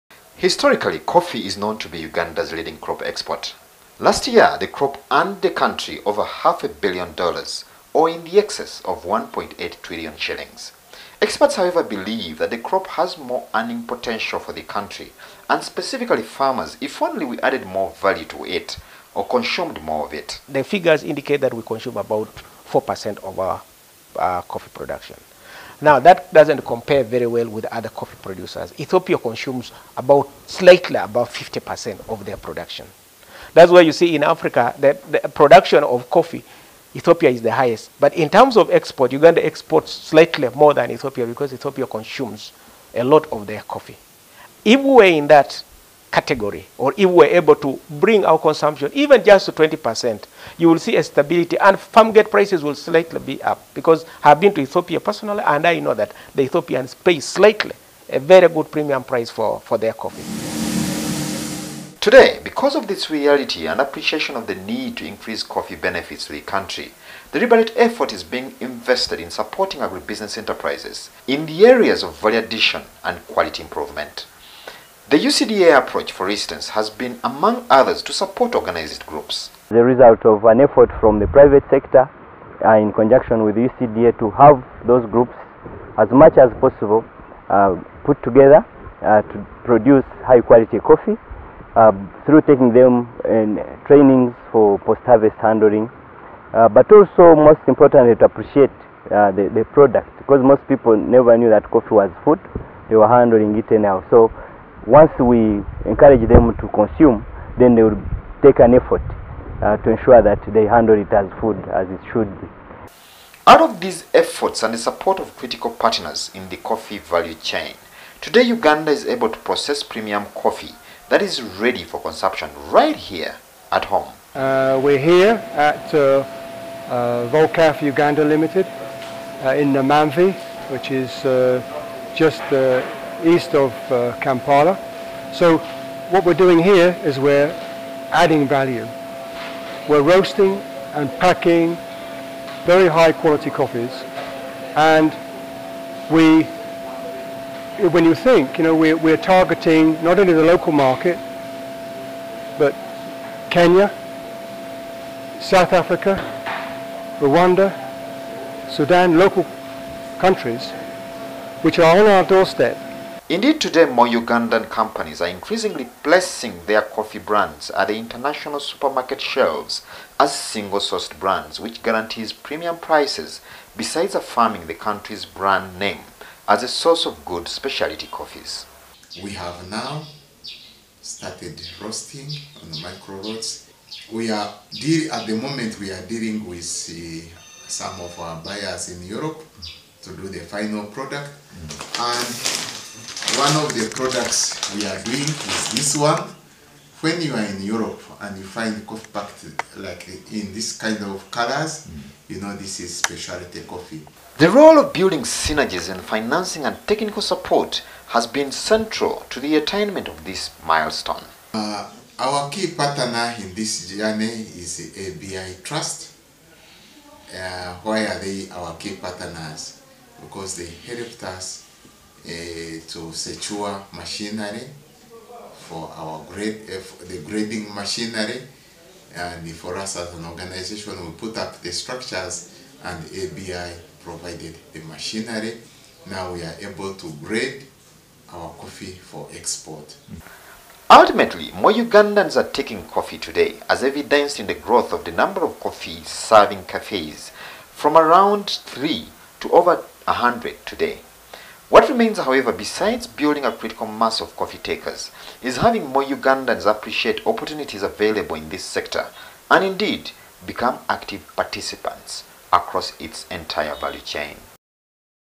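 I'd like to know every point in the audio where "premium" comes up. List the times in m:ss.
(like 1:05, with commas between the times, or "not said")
0:58, 1:59, 2:52.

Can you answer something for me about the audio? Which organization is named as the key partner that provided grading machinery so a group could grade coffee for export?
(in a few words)
ABI Trust.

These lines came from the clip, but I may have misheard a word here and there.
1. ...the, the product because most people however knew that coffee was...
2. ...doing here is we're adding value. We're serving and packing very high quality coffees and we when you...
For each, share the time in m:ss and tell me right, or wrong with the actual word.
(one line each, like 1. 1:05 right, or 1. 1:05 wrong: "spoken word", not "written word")
1. 1:39 wrong: "never", not "however"
2. 2:16 wrong: "roasting", not "serving".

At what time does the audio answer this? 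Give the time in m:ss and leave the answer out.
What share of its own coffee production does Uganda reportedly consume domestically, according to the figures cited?
0:22.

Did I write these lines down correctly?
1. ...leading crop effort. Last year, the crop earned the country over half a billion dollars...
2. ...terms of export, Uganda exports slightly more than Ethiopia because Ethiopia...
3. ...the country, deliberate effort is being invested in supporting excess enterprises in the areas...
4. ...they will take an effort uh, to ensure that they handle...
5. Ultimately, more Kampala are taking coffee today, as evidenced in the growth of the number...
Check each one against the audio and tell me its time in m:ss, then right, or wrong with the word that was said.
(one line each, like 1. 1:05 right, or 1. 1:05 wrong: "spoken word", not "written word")
1. 0:02 wrong: "export", not "effort"
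2. 0:38 right
3. 1:06 wrong: "agribusiness", not "excess"
4. 1:47 right
5. 4:00 wrong: "Ugandans", not "Kampala".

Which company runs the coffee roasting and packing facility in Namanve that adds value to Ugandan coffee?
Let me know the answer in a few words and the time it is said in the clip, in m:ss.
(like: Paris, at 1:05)
Volcafe Uganda Limited, at 2:07.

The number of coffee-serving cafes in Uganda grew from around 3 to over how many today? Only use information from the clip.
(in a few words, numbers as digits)
100.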